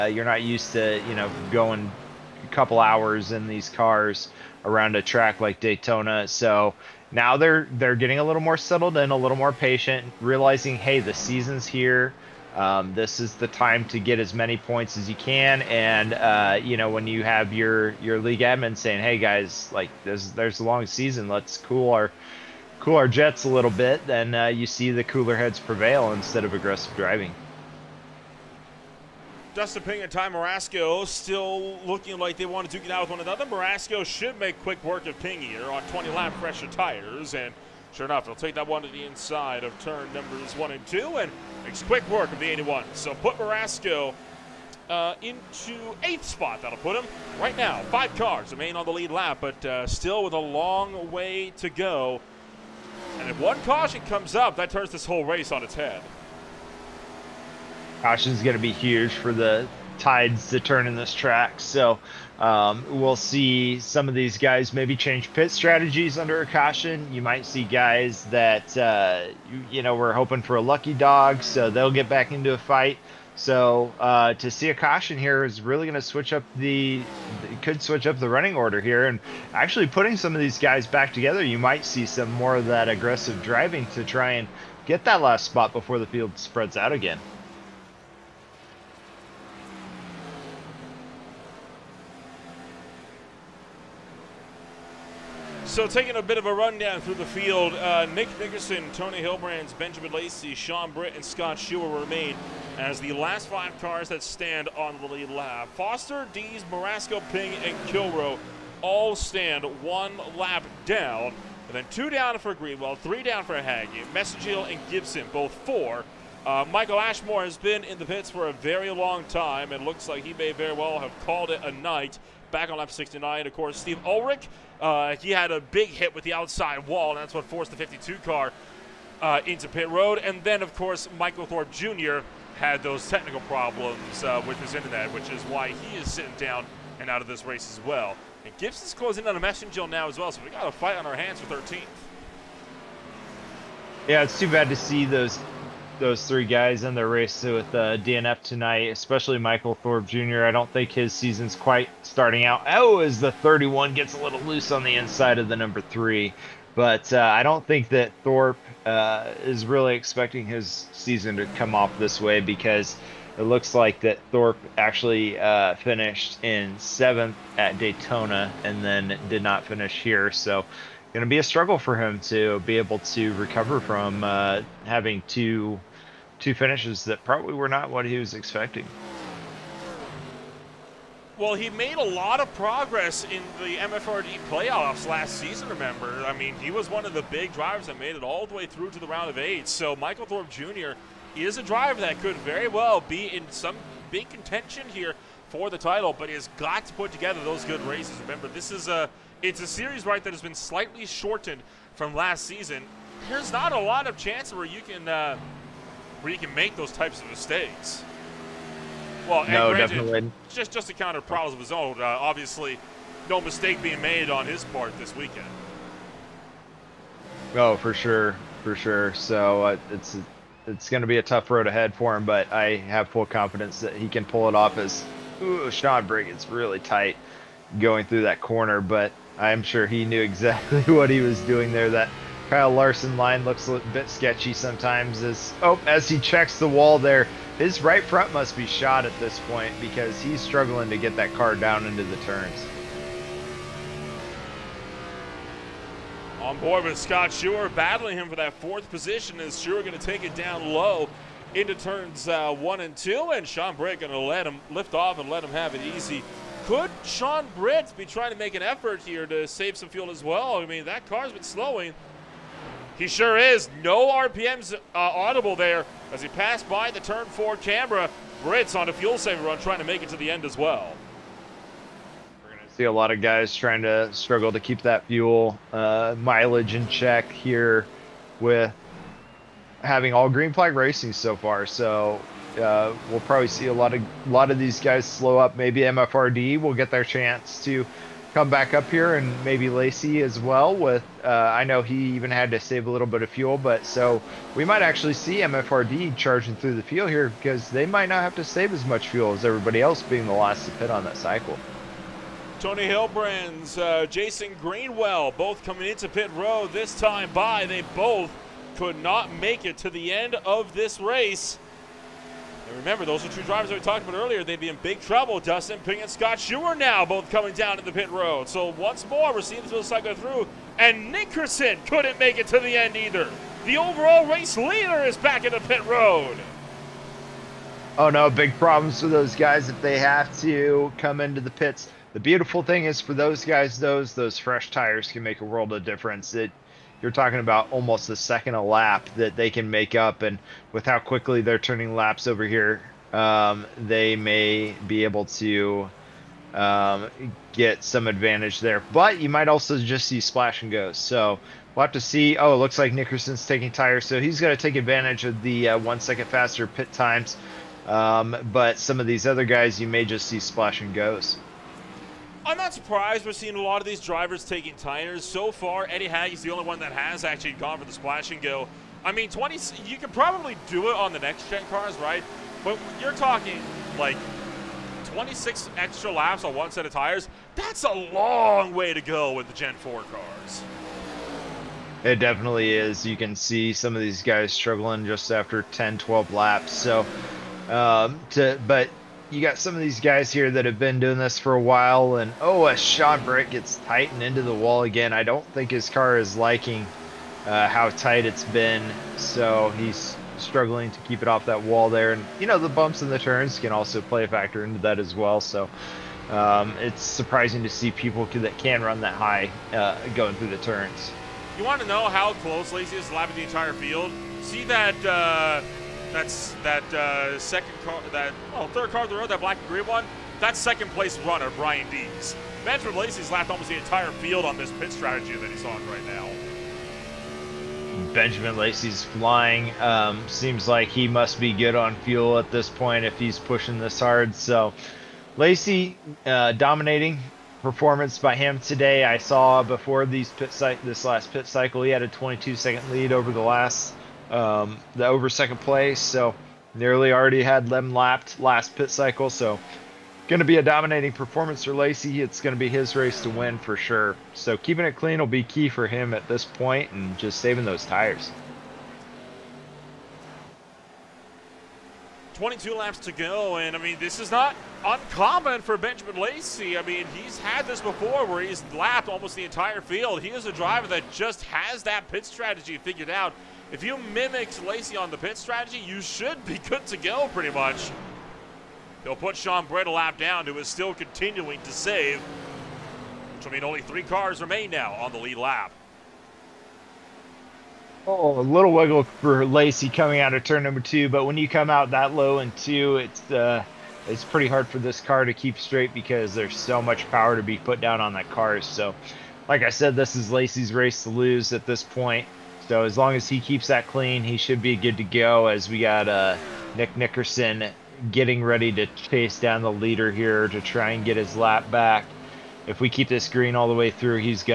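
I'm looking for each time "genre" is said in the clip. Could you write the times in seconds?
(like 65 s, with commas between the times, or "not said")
not said.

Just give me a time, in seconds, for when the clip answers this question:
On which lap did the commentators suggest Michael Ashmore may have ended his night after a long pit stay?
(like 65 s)
122 s.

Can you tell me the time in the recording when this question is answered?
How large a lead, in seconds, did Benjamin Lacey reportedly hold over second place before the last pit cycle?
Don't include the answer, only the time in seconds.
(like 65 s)
442 s.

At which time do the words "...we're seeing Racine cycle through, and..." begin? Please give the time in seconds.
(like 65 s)
319 s.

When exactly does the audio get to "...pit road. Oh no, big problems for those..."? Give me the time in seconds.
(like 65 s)
325 s.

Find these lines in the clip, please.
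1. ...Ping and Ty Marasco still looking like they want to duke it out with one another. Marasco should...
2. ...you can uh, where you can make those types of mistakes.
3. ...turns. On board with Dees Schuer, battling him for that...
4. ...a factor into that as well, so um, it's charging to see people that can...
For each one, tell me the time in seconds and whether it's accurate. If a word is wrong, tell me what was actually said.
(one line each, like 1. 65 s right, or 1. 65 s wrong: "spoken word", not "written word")
1. 29 s right
2. 204 s right
3. 242 s wrong: "Scott", not "Dees"
4. 404 s wrong: "surprising", not "charging".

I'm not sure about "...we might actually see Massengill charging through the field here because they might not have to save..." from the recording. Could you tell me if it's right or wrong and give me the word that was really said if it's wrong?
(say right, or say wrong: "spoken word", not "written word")
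wrong: "MFRD", not "Massengill".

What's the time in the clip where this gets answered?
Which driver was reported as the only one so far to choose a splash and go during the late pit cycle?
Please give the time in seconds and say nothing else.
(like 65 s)
365 s.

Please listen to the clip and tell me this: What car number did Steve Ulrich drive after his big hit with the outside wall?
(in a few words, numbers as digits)
52.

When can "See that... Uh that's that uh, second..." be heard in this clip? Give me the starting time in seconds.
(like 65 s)
414 s.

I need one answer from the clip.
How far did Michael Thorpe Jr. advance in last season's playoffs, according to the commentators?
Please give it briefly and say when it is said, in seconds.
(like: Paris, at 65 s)
Round of eight, at 189 s.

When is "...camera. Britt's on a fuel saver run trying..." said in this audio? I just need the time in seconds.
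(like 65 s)
267 s.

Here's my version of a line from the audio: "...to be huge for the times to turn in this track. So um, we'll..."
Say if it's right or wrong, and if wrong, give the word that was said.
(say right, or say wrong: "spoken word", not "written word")
wrong: "tides", not "times".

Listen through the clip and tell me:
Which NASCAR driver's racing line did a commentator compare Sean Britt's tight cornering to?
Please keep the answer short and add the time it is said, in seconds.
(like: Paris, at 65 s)
Kyle Larson, at 232 s.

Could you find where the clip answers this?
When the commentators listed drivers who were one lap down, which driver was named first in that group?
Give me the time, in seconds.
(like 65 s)
105 s.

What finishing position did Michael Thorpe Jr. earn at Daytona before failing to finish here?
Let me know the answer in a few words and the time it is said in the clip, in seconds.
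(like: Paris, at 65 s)
7th, at 166 s.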